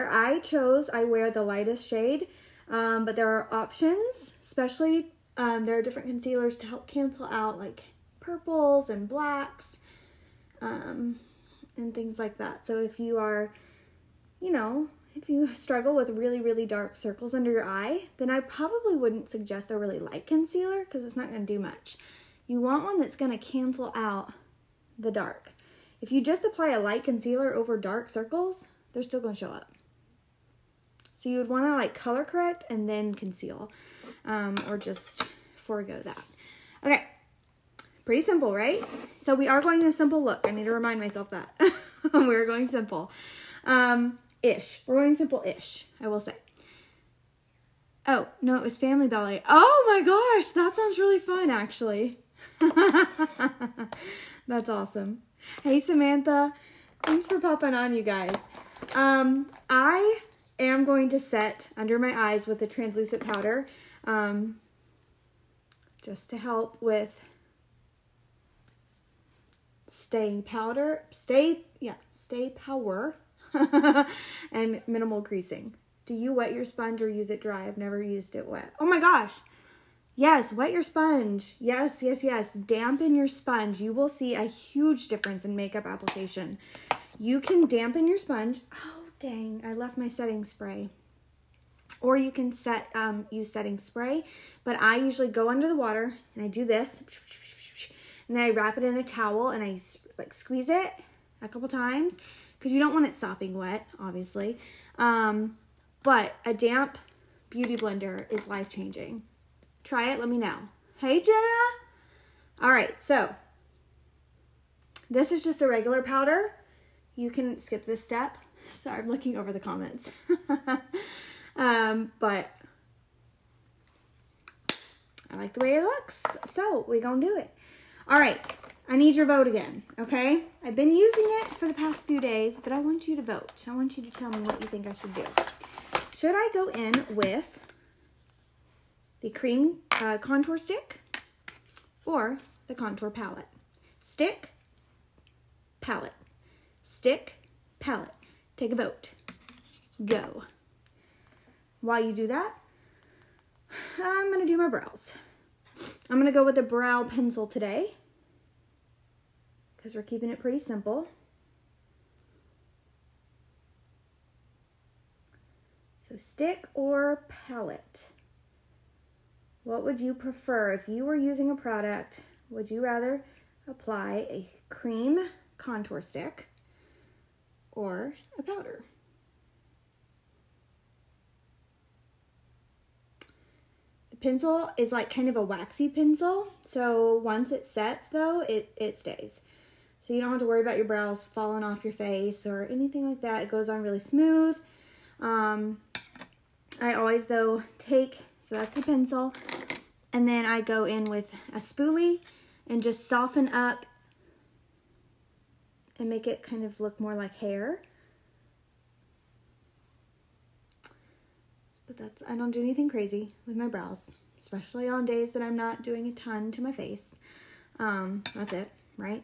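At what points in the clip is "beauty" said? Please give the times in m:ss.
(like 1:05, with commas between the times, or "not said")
1:47.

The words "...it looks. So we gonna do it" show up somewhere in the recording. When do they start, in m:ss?
2:05.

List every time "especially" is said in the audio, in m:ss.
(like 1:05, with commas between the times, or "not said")
0:04, 3:34.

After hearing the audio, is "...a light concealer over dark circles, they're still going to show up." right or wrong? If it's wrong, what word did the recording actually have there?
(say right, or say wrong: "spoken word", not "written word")
right.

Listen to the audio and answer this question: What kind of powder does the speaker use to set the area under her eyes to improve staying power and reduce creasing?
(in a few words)
translucent powder.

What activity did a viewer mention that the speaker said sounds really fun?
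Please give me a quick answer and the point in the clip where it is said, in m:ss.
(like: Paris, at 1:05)
Family Ballet, at 0:48.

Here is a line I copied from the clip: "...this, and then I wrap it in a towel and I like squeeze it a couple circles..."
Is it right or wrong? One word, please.
wrong.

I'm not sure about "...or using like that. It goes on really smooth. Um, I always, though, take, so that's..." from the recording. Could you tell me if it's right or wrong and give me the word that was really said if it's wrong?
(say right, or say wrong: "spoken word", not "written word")
wrong: "anything", not "using".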